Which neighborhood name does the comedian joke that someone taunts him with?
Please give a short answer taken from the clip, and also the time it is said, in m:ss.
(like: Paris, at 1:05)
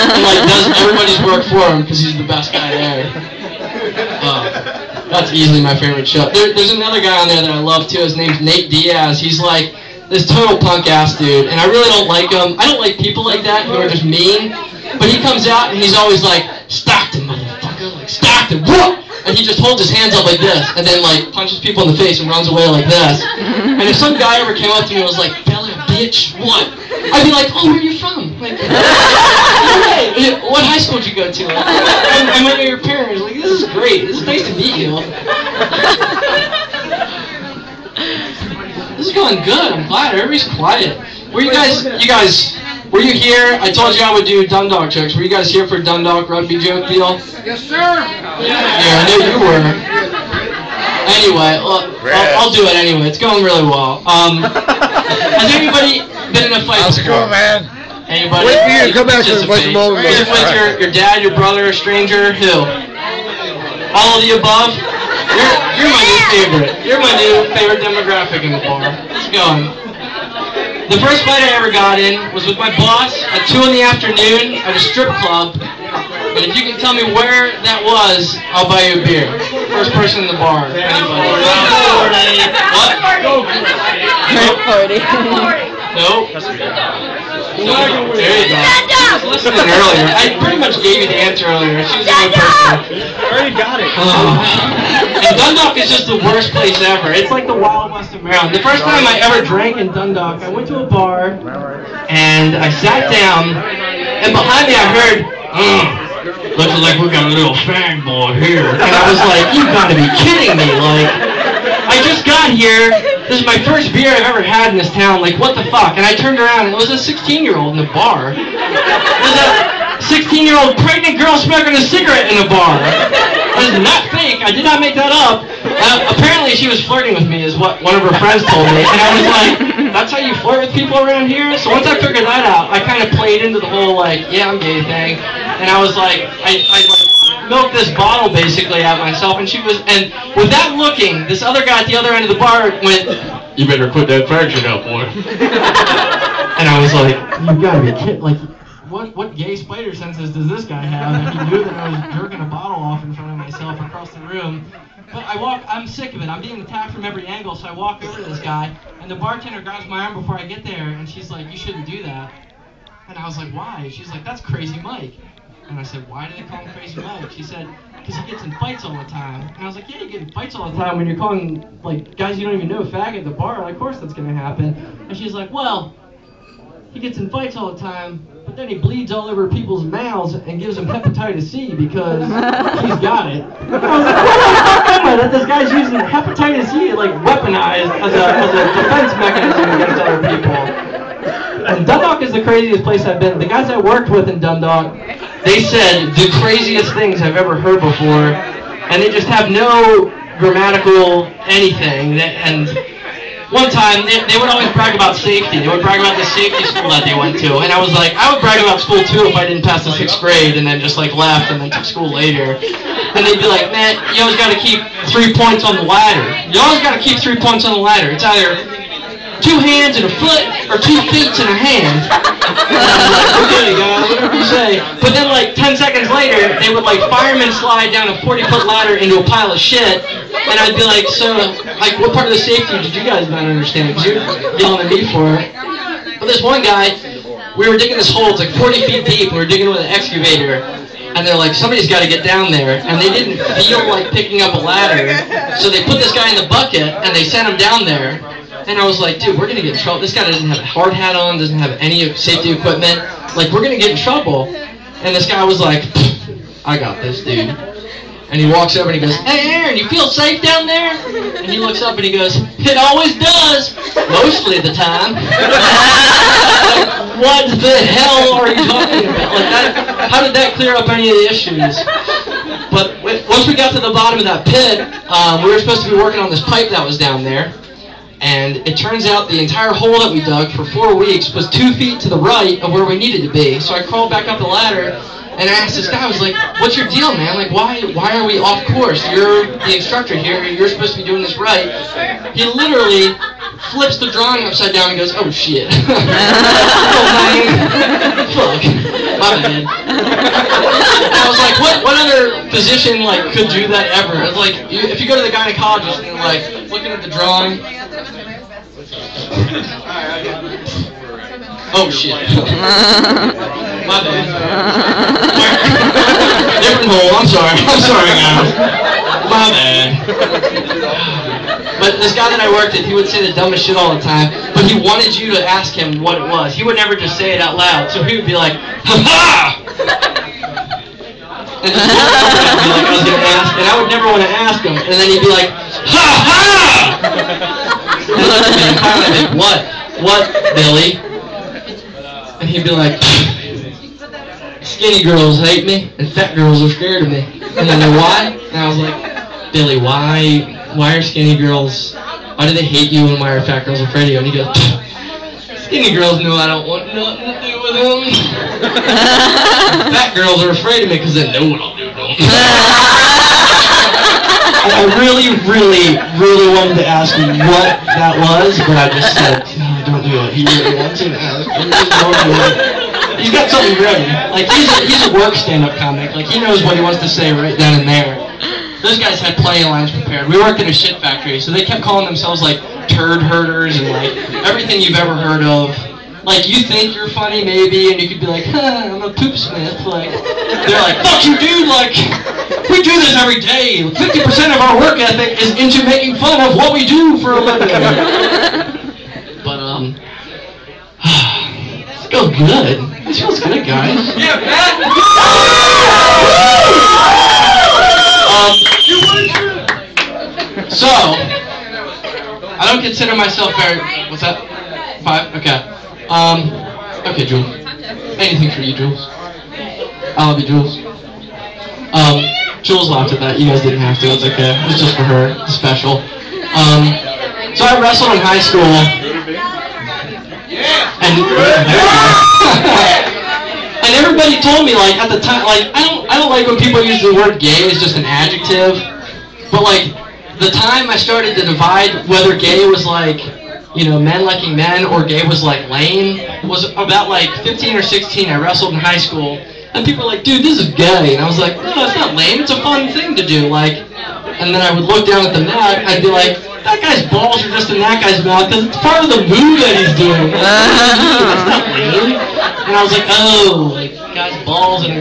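Bel Air, at 0:25.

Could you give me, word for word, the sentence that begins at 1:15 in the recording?
But if you can tell me where that was, I'll buy you a beer.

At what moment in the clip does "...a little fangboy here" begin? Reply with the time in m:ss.
1:47.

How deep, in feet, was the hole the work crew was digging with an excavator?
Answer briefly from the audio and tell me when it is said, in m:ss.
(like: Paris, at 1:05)
40 feet, at 3:58.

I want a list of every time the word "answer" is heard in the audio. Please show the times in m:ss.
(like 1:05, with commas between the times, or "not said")
1:31.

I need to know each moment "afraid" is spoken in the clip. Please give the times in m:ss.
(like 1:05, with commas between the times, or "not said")
5:53, 6:00.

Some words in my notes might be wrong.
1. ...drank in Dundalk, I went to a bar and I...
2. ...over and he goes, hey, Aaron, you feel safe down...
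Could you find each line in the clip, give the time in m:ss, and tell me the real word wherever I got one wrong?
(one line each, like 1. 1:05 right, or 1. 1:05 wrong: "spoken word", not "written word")
1. 1:39 right
2. 4:18 right.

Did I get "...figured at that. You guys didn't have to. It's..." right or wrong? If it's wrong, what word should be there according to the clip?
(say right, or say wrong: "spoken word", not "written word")
wrong: "laughed", not "figured".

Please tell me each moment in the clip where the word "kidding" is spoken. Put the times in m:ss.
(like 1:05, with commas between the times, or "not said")
1:50, 2:27.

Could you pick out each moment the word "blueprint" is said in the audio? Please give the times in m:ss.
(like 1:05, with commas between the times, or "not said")
not said.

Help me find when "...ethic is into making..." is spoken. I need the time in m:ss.
6:35.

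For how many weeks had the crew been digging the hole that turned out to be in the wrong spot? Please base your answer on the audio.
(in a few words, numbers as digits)
4.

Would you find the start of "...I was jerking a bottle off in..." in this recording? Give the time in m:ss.
2:31.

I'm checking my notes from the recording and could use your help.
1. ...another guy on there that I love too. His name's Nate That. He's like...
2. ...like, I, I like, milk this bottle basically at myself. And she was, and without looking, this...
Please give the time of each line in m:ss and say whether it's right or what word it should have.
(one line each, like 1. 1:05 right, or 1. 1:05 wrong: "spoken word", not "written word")
1. 0:06 wrong: "Diaz", not "That"
2. 2:15 right.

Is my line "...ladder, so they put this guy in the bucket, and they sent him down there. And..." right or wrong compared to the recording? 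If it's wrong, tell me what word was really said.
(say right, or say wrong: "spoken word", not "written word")
right.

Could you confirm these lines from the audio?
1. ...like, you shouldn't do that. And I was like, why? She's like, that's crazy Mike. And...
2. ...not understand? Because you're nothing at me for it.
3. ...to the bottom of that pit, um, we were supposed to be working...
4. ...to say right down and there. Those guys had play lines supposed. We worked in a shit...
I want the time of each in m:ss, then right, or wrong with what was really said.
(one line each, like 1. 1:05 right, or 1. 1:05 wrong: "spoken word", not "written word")
1. 2:41 right
2. 3:53 wrong: "yelling", not "nothing"
3. 4:33 right
4. 6:17 wrong: "prepared", not "supposed".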